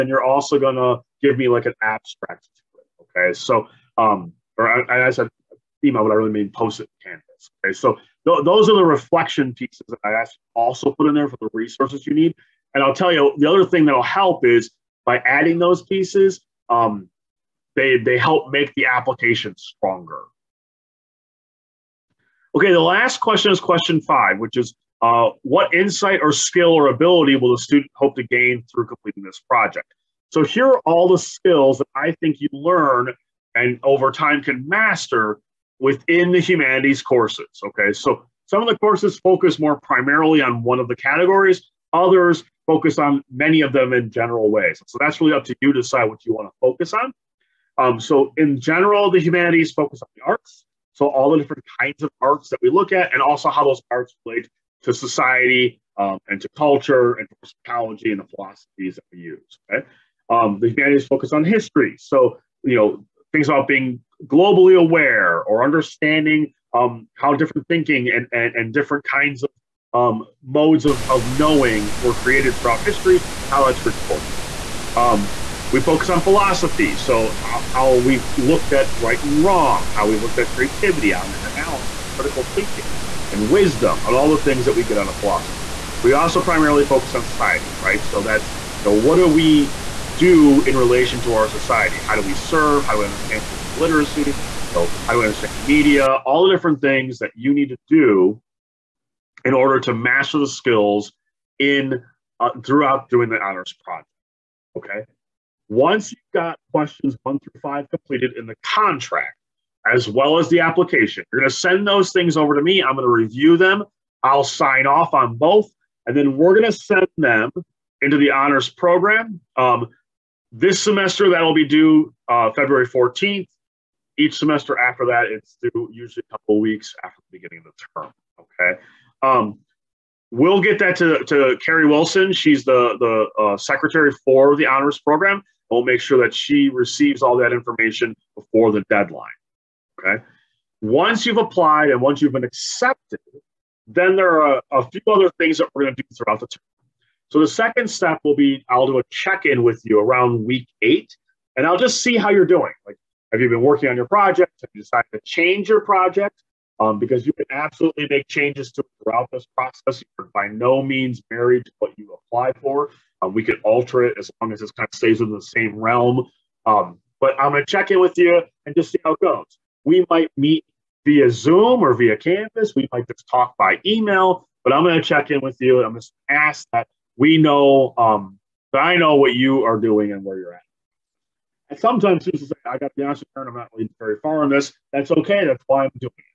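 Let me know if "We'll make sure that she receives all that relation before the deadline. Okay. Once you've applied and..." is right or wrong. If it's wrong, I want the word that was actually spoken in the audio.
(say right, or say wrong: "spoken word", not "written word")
wrong: "information", not "relation".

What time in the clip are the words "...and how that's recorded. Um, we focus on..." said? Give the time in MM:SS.
01:13.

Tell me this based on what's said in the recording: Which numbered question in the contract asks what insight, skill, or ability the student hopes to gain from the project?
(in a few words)
Question 5.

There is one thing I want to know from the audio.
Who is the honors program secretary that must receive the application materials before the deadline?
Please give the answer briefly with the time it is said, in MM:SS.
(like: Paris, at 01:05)
Carrie Wilson, at 02:11.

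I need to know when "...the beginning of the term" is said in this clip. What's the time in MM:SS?
02:07.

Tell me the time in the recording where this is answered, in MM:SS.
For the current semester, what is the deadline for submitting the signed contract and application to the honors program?
02:02.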